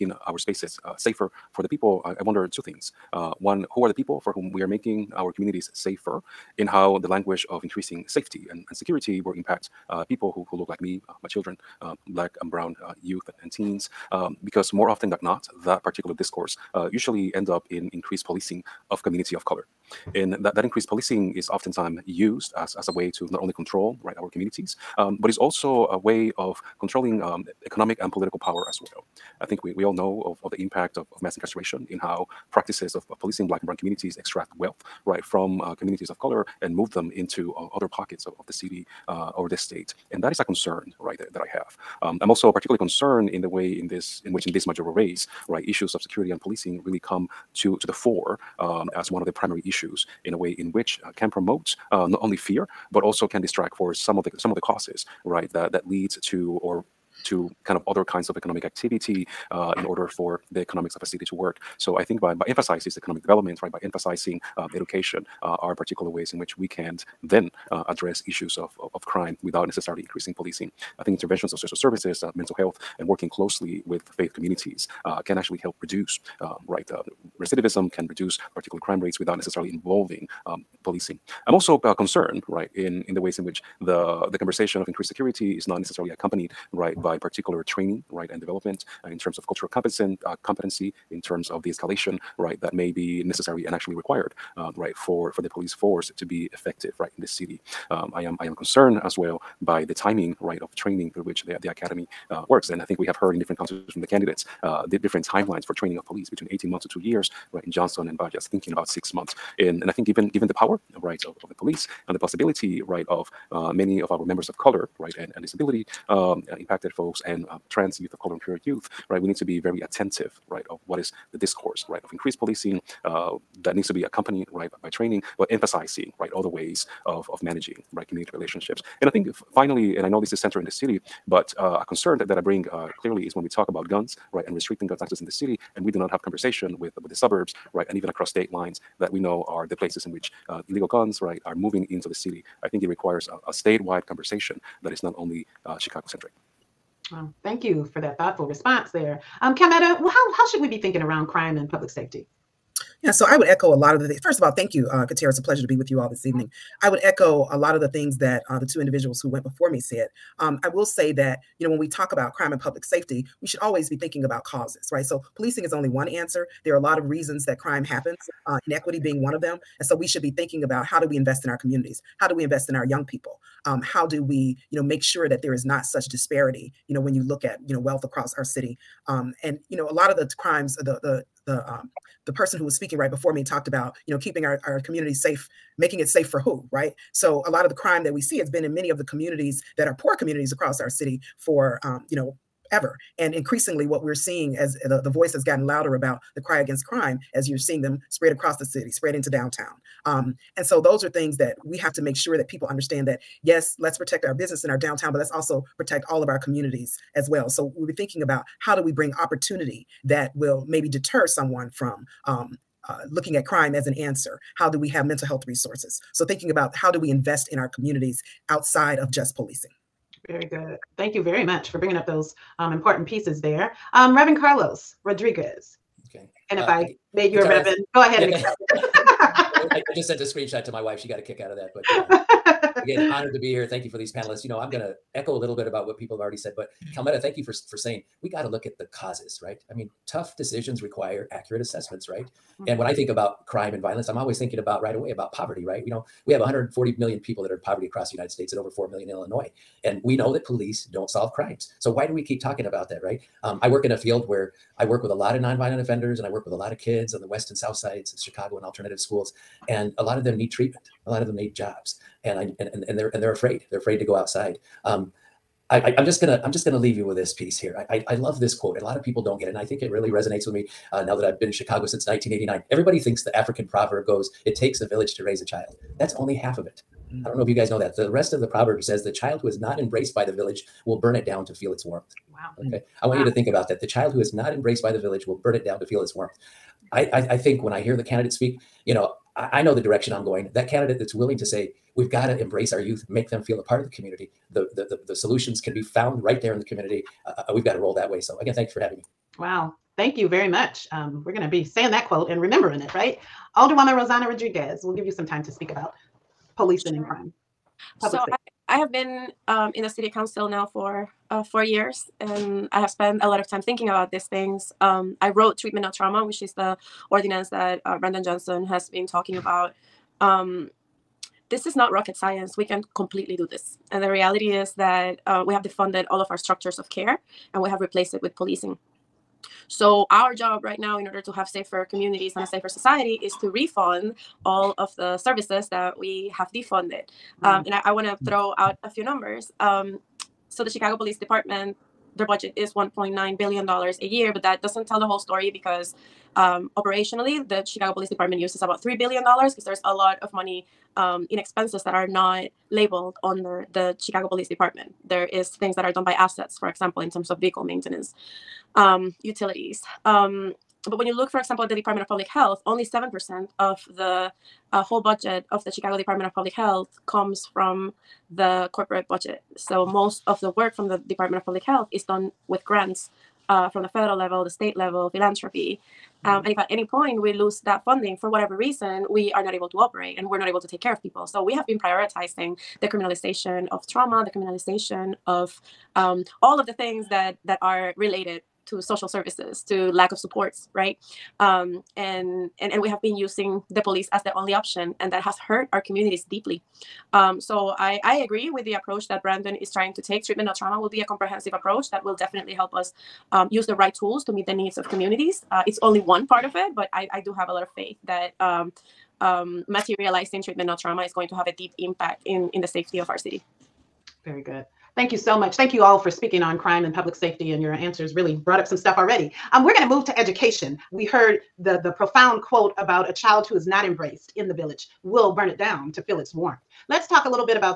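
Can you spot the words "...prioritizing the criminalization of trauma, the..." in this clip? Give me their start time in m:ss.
6:21.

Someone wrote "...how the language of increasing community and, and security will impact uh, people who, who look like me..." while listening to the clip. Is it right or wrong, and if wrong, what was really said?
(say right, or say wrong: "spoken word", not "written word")
wrong: "safety", not "community".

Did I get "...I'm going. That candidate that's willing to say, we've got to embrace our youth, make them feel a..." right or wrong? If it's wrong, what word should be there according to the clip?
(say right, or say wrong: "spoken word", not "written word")
right.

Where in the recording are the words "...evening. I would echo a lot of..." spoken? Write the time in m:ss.
2:36.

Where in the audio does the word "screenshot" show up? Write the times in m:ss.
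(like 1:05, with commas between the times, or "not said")
3:50.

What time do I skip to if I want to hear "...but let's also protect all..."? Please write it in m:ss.
3:25.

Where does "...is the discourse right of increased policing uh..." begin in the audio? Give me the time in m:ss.
2:00.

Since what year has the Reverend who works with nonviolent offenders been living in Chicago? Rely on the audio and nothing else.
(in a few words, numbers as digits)
1989.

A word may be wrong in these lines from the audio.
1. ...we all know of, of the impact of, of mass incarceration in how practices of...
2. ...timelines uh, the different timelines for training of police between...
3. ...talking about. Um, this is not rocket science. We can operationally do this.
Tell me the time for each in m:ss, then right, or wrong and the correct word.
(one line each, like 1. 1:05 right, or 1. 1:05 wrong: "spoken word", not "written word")
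1. 0:29 right
2. 1:44 wrong: "candidates", not "timelines"
3. 5:19 wrong: "completely", not "operationally".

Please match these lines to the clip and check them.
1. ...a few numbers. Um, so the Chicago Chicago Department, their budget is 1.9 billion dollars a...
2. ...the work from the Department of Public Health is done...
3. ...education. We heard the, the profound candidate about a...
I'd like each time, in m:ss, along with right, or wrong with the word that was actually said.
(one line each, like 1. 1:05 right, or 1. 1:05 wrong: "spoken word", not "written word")
1. 5:38 wrong: "Police", not "Chicago"
2. 6:10 right
3. 7:00 wrong: "quote", not "candidate".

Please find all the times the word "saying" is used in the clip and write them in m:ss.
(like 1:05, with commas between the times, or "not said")
3:57, 5:01.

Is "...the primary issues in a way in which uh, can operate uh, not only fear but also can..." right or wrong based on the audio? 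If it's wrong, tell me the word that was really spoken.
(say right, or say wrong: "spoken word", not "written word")
wrong: "promote", not "operate".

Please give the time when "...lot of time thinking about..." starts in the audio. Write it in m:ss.
5:13.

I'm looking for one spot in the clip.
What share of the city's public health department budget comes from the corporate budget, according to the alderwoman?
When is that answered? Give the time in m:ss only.
6:02.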